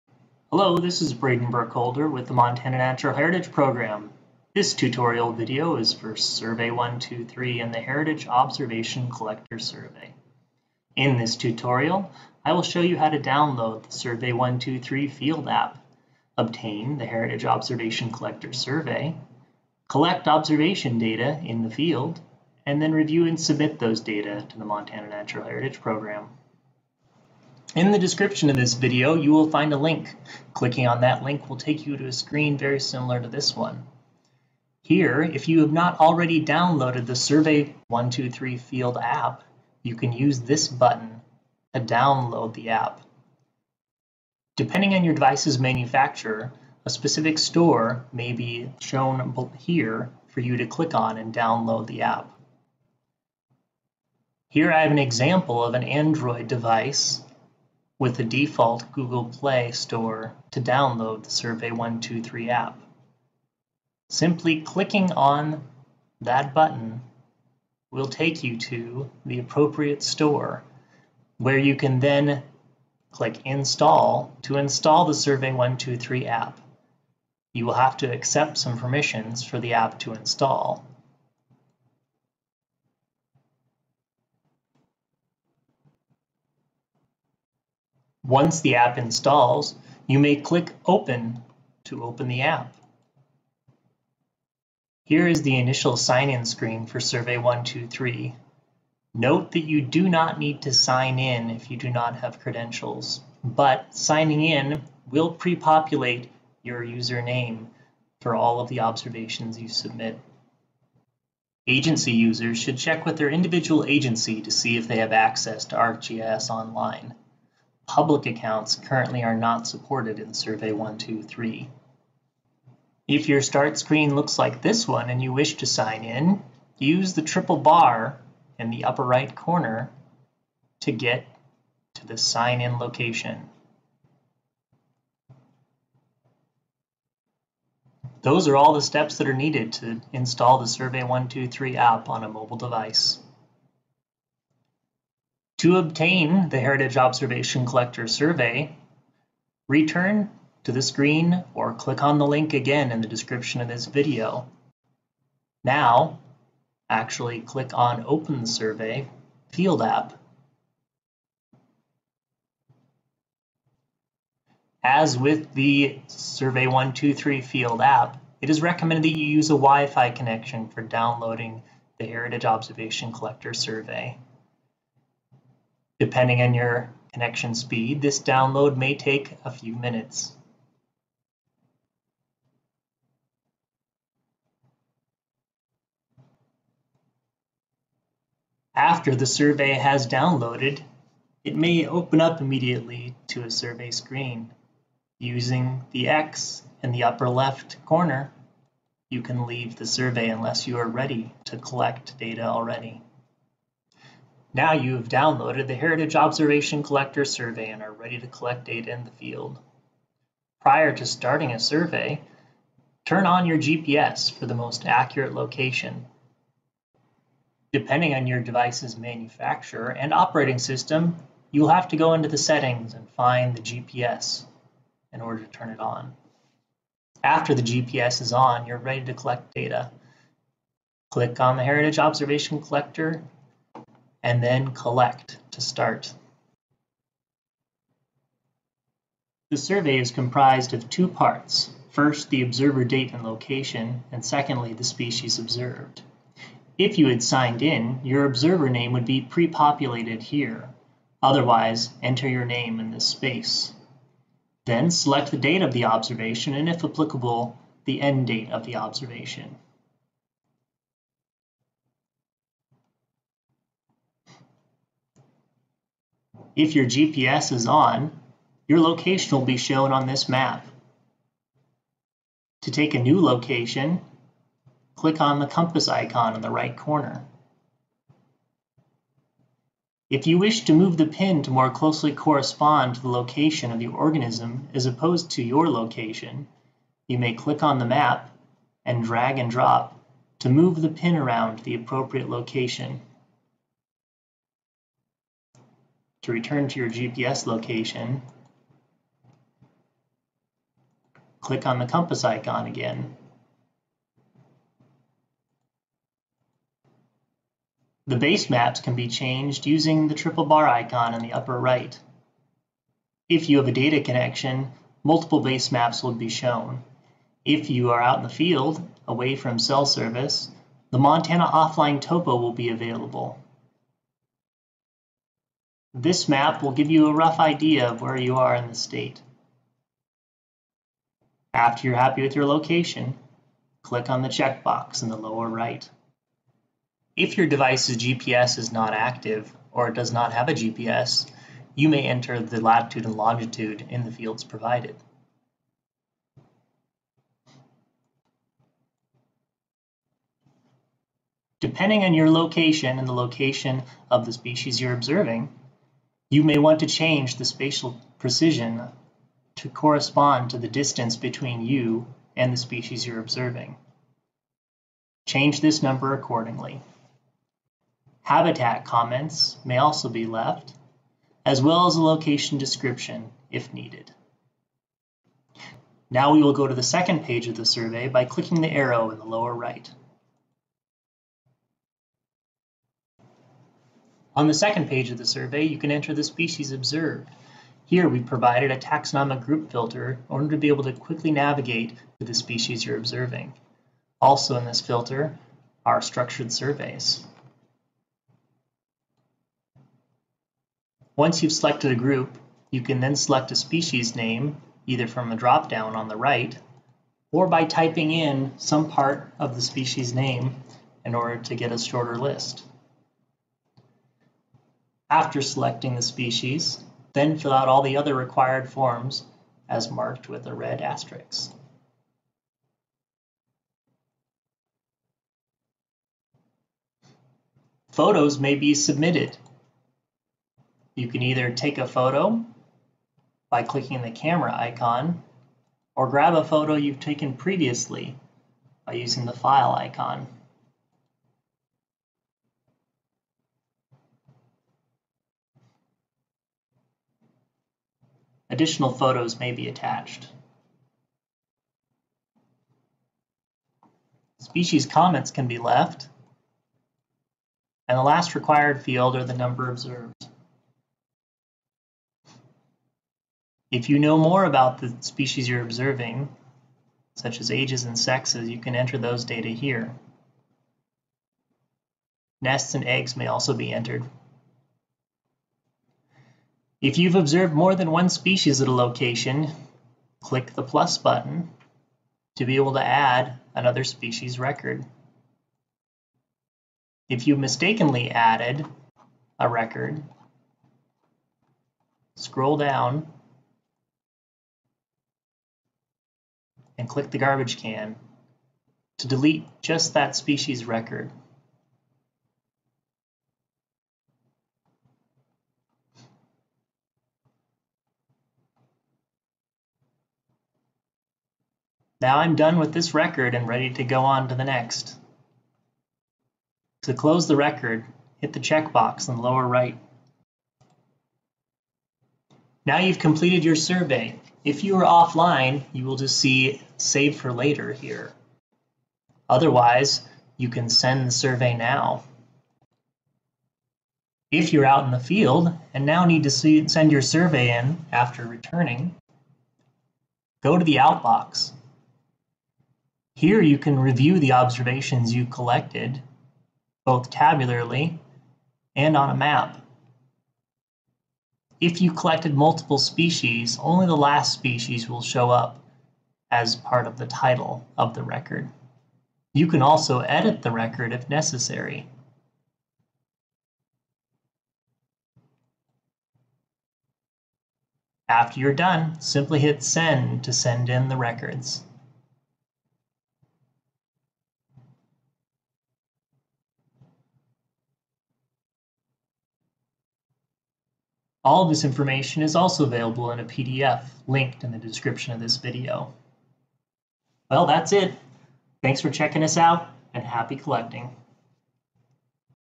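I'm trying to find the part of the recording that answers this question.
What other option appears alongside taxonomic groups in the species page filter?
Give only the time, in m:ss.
6:36.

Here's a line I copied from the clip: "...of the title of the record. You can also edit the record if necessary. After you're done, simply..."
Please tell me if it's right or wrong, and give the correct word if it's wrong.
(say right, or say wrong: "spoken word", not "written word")
right.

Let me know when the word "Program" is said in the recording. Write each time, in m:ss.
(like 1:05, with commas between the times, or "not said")
0:03, 0:25.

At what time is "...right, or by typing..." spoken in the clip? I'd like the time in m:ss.
6:46.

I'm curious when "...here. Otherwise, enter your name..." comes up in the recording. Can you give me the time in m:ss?
4:10.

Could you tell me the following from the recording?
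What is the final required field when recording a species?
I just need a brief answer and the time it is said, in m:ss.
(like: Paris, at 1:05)
number observed, at 7:39.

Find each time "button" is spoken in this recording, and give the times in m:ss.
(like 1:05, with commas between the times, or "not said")
0:40, 1:06, 8:00.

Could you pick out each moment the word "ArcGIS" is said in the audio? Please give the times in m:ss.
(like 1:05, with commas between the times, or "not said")
1:55.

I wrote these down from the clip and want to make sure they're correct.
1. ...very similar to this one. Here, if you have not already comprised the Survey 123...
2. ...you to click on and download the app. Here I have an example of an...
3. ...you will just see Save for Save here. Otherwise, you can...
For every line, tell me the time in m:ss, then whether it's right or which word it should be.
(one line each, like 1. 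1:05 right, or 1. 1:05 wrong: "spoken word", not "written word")
1. 0:32 wrong: "downloaded", not "comprised"
2. 0:50 right
3. 8:45 wrong: "Later", not "Save".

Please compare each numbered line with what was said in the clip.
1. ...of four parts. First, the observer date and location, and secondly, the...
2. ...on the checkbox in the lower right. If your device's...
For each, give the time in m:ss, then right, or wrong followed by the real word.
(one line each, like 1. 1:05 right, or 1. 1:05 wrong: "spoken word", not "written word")
1. 4:00 wrong: "two", not "four"
2. 5:34 right.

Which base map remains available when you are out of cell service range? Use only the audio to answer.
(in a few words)
Montana Offline Topo.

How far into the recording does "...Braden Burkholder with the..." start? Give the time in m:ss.
0:01.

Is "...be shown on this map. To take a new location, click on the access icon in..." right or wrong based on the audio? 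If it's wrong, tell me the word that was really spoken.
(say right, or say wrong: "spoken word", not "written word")
wrong: "compass", not "access".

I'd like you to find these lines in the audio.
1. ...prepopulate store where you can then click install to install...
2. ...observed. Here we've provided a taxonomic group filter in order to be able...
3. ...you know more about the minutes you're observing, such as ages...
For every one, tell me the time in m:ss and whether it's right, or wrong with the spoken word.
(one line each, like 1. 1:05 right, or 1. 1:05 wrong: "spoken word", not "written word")
1. 1:09 wrong: "appropriate", not "prepopulate"
2. 6:26 right
3. 7:43 wrong: "species", not "minutes".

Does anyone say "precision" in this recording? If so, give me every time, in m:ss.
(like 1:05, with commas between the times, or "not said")
5:58.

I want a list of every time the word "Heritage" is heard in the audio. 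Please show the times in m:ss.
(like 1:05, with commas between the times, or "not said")
0:03, 0:07, 0:17, 0:25, 2:26, 2:52, 3:25, 3:51.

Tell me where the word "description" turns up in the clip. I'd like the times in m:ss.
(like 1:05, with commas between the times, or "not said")
0:27, 2:33, 6:12, 9:44.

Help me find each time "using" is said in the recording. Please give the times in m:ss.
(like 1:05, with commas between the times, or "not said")
3:15, 5:09, 7:18.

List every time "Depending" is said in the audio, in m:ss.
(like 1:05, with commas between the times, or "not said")
0:44, 2:56, 3:37, 5:51.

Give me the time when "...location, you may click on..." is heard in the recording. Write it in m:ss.
4:45.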